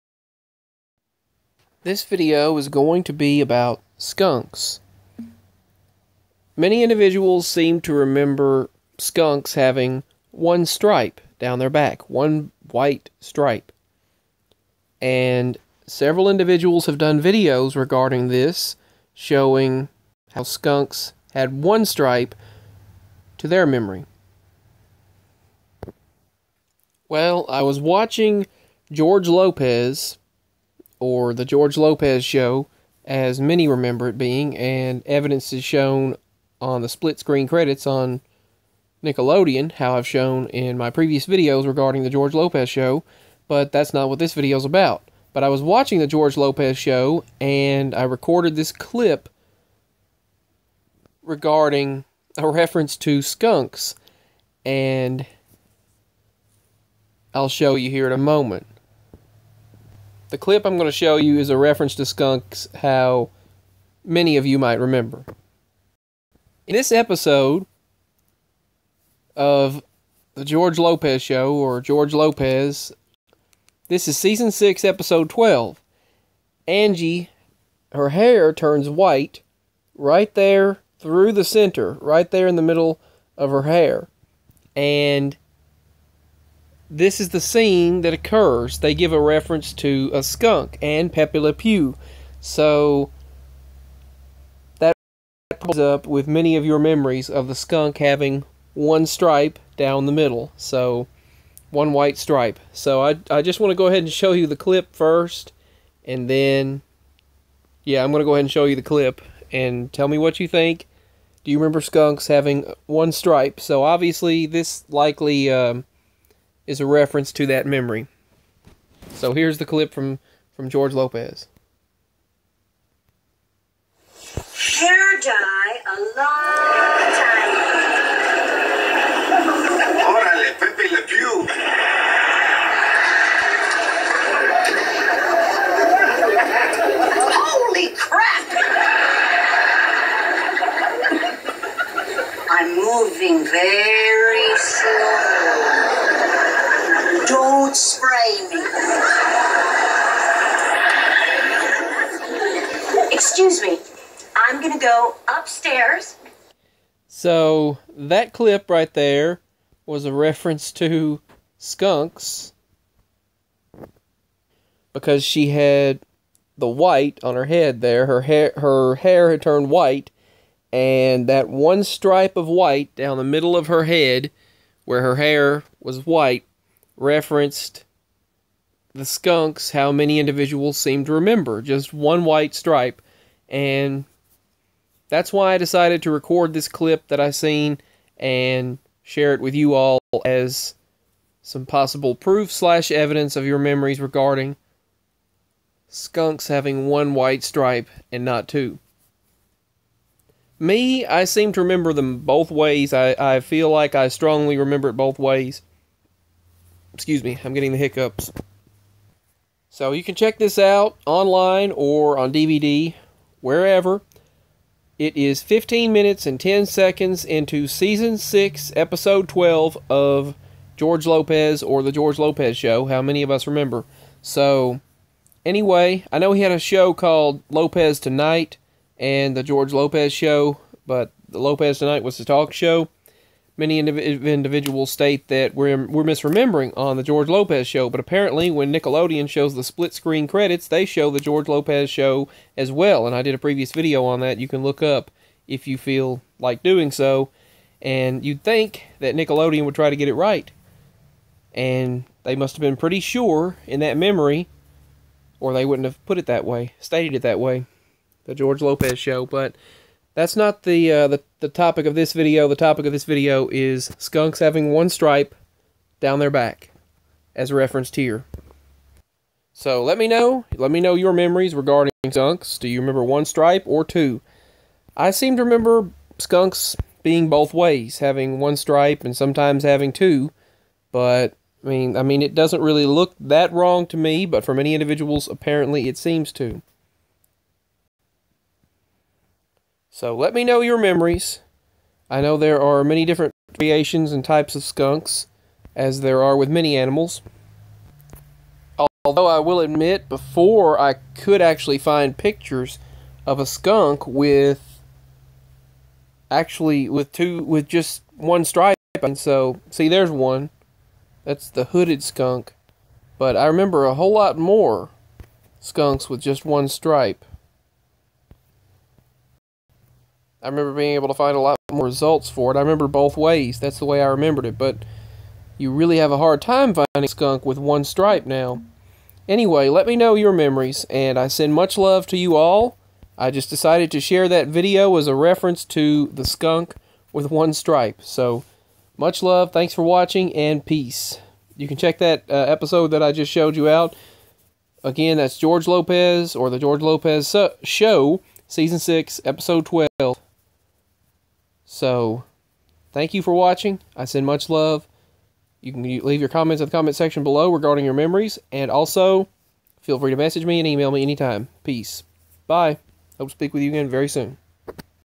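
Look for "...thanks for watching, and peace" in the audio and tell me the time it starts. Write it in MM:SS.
05:39.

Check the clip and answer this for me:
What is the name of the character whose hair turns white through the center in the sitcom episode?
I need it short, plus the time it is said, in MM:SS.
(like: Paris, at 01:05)
Angie, at 01:16.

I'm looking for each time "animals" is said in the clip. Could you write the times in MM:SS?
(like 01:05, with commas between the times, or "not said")
04:56.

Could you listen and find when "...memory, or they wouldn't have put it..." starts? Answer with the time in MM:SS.
04:13.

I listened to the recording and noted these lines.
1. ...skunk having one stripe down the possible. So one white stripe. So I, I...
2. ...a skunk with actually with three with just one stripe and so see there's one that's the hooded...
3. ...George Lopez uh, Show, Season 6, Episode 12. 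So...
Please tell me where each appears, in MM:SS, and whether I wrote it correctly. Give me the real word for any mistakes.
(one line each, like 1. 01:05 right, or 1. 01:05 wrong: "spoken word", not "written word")
1. 01:37 wrong: "middle", not "possible"
2. 05:03 wrong: "two", not "three"
3. 05:46 right.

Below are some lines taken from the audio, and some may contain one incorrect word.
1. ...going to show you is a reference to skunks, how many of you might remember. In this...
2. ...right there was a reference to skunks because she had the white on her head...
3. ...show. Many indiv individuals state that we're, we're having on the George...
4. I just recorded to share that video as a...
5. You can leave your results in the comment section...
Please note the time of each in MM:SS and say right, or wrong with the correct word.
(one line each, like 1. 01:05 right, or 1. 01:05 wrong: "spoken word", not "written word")
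1. 01:00 right
2. 02:38 right
3. 03:52 wrong: "misremembering", not "having"
4. 05:33 wrong: "decided", not "recorded"
5. 05:55 wrong: "comments", not "results".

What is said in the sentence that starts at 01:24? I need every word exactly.
And this is the scene that occurs.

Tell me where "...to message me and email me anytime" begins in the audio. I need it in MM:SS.
06:00.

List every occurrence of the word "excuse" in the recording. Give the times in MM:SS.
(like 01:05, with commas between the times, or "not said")
02:33, 03:26.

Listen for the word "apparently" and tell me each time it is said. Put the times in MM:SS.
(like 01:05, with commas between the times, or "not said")
03:57, 04:45.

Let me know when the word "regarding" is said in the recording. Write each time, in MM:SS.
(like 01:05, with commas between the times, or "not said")
00:17, 00:41, 00:51, 03:13, 04:31, 05:57.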